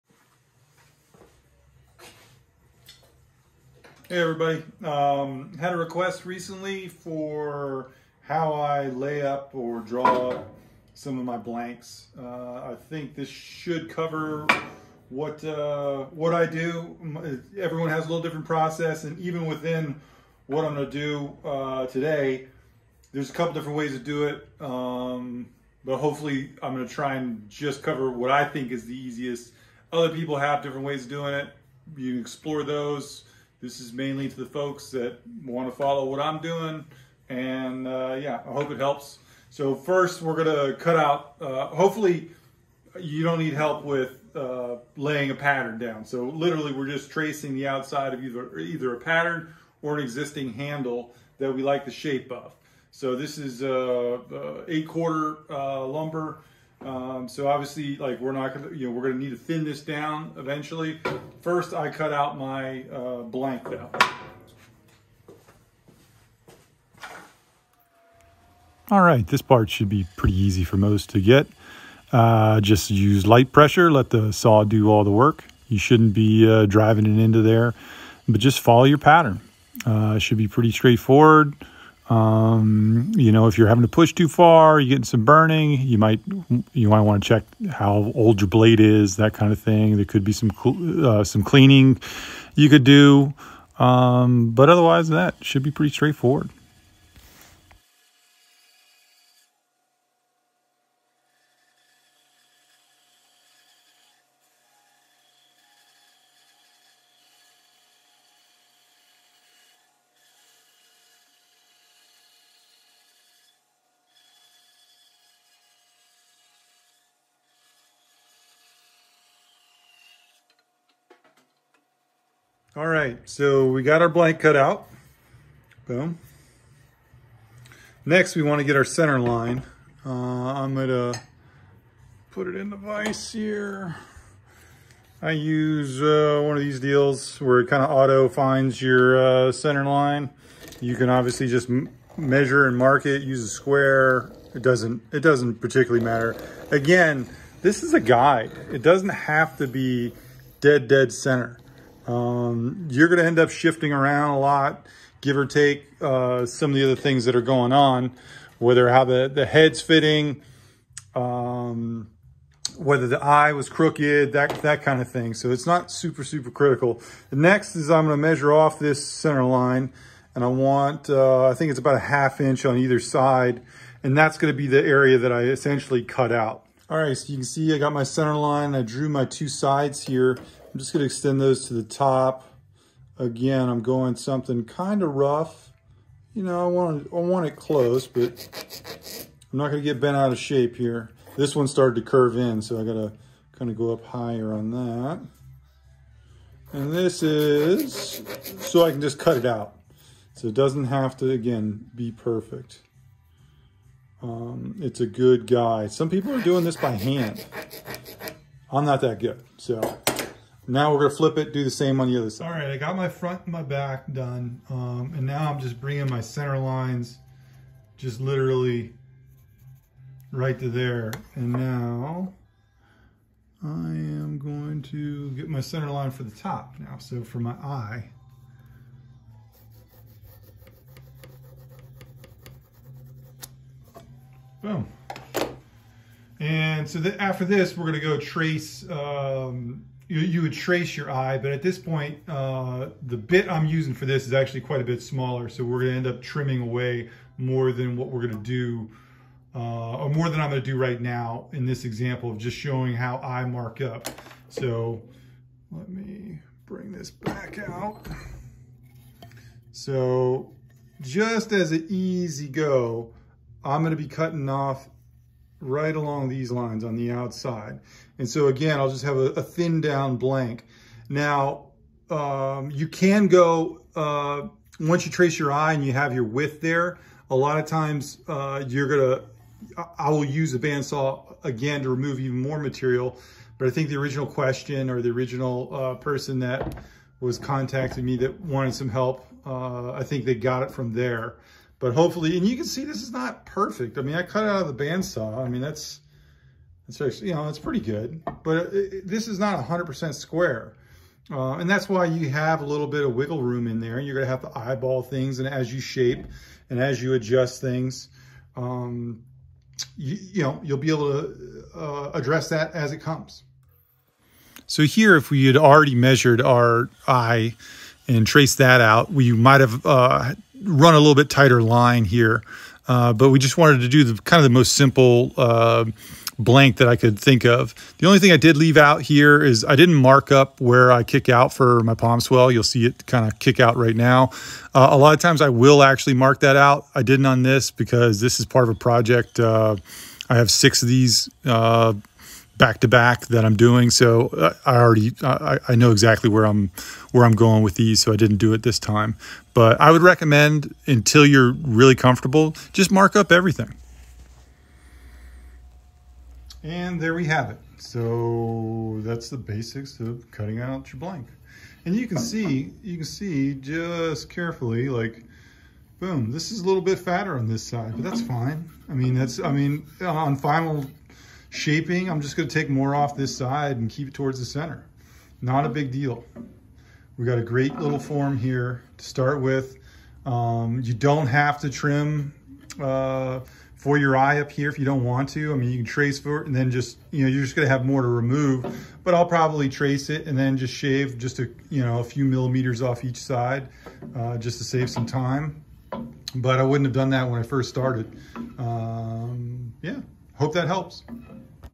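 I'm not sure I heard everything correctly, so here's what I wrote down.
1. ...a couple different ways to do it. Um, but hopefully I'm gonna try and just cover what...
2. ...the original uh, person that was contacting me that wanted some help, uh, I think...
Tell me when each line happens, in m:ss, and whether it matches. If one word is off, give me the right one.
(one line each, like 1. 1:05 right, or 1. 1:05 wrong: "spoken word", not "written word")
1. 0:23 right
2. 4:45 right.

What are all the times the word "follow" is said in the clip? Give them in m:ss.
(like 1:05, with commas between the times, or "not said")
0:35, 1:18.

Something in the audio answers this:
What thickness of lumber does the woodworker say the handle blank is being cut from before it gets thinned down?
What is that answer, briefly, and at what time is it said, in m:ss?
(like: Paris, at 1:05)
8/4 (eight quarter), at 0:54.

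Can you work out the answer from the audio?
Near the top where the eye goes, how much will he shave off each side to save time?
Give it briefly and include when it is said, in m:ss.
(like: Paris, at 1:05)
a few millimeters, at 6:31.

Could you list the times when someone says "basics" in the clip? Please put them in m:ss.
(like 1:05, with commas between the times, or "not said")
5:59.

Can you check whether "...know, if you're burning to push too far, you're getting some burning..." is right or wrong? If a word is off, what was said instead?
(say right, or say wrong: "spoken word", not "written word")
wrong: "having", not "burning".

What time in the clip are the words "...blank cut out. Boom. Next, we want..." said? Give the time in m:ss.
2:04.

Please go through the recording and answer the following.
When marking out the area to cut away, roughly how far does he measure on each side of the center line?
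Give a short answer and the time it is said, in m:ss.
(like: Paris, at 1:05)
half inch, at 2:51.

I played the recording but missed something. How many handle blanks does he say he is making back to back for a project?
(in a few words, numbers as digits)
6.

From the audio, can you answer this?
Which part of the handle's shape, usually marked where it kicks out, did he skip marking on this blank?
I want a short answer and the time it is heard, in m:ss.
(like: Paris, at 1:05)
palm swell, at 5:31.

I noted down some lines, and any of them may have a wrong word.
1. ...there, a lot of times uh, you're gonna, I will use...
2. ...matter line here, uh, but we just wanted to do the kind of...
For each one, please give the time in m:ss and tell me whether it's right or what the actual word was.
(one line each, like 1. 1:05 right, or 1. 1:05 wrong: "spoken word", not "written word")
1. 4:36 right
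2. 5:21 wrong: "tighter", not "matter".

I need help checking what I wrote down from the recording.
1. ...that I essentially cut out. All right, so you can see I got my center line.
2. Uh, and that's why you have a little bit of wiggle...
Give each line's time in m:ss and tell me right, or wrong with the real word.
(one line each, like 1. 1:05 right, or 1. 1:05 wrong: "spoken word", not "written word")
1. 2:55 right
2. 5:01 right.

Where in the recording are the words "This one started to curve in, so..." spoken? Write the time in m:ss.
3:11.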